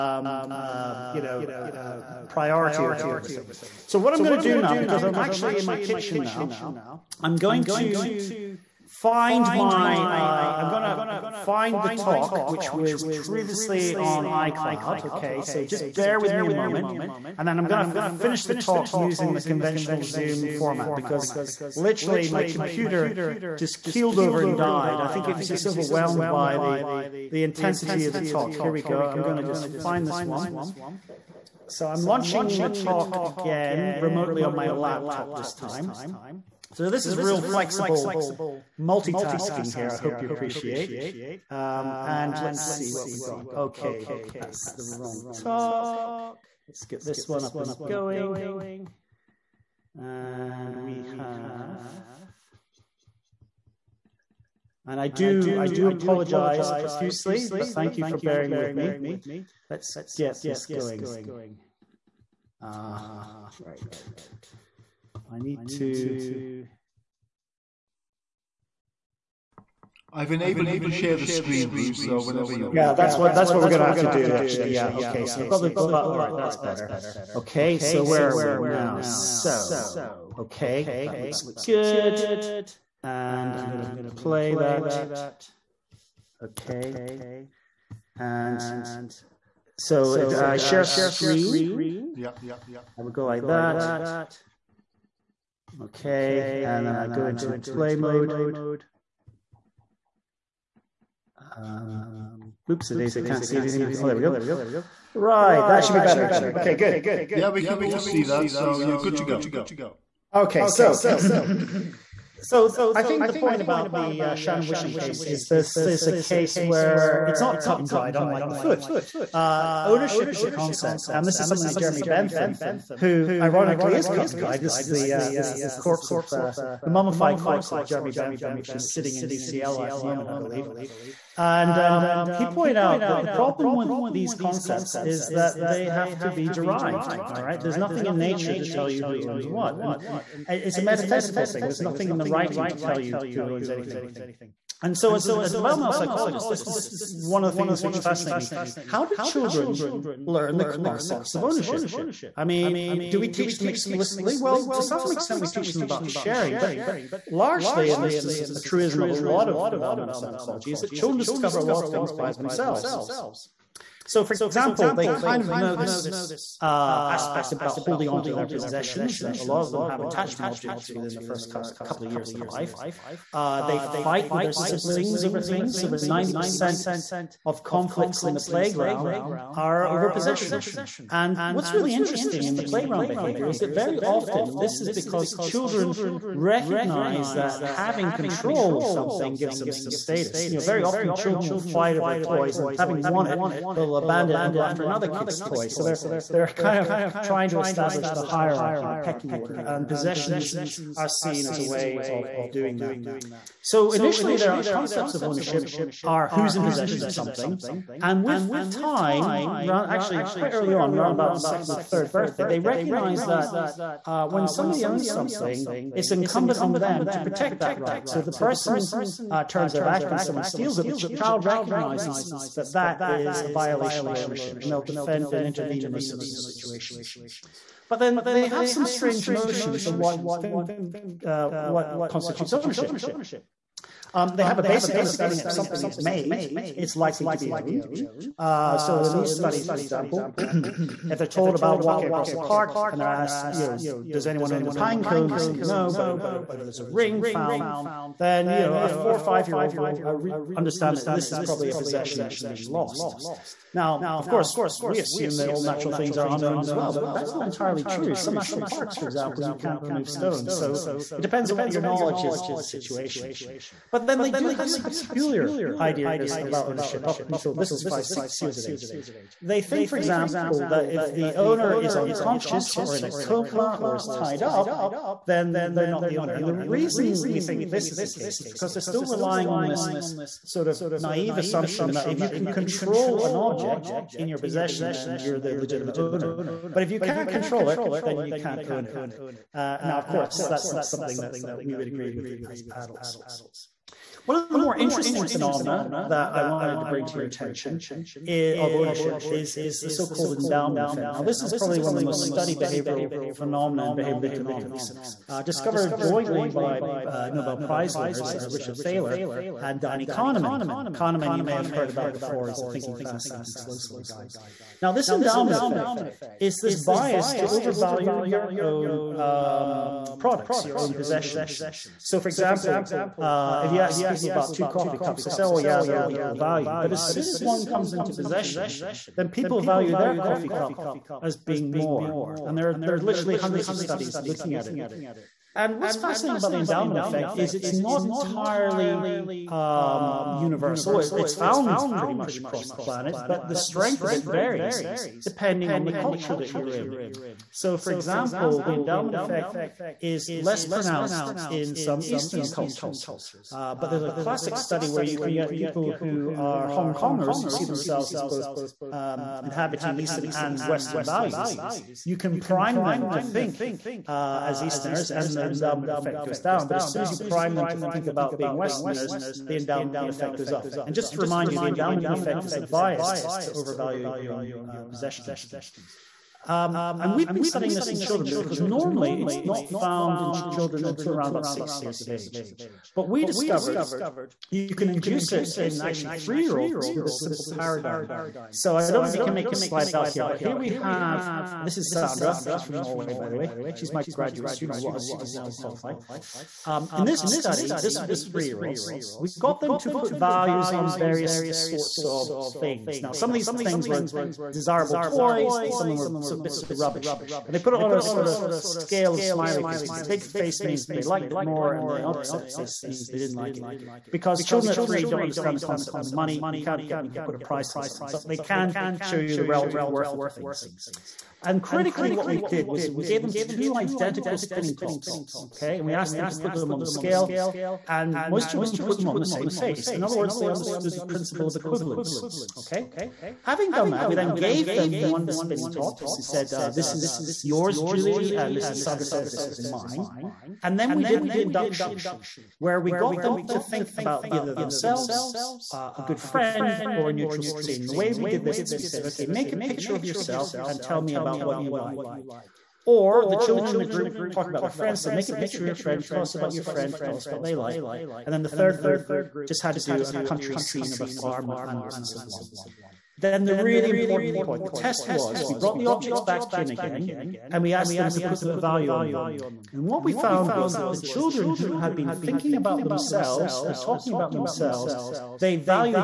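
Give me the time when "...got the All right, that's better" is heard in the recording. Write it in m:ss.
1:15.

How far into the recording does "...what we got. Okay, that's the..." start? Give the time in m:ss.
0:42.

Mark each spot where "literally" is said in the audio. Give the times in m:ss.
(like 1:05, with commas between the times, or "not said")
0:21, 5:33.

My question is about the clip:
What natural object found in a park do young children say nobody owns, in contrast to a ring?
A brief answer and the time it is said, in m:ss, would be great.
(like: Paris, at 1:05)
pine cone, at 4:04.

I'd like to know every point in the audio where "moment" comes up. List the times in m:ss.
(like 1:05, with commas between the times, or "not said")
0:16, 2:10.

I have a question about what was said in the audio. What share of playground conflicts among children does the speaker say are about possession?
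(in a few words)
Over 90%.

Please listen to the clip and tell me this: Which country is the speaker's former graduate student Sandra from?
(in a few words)
Norway.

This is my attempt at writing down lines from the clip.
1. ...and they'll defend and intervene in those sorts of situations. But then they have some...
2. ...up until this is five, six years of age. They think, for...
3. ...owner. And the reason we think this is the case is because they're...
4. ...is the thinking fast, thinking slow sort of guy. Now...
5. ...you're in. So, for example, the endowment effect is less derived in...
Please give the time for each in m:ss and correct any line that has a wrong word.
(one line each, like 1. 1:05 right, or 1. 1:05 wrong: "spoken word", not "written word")
1. 3:44 right
2. 4:27 right
3. 4:36 right
4. 5:12 right
5. 5:46 wrong: "pronounced", not "derived".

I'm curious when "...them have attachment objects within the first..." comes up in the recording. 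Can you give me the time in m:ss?
2:49.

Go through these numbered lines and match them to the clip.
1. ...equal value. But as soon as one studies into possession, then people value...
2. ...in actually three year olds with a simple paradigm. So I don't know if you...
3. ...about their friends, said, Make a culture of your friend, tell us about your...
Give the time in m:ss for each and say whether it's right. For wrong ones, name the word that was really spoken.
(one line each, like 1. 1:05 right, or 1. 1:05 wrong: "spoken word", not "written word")
1. 5:26 wrong: "comes", not "studies"
2. 6:25 right
3. 7:34 wrong: "picture", not "culture".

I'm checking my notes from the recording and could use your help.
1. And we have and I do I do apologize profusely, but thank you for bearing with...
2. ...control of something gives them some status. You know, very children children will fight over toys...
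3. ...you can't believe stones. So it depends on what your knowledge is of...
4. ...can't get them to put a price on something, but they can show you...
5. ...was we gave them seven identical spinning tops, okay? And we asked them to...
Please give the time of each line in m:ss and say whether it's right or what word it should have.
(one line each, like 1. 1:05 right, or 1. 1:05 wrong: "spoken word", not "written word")
1. 0:49 right
2. 3:08 wrong: "often", not "children"
3. 4:19 wrong: "remove", not "believe"
4. 6:56 right
5. 7:02 wrong: "two", not "seven".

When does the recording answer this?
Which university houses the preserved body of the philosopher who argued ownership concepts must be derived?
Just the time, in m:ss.
2:09.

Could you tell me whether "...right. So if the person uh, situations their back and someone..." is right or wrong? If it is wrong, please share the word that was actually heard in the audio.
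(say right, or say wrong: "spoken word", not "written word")
wrong: "turns", not "situations".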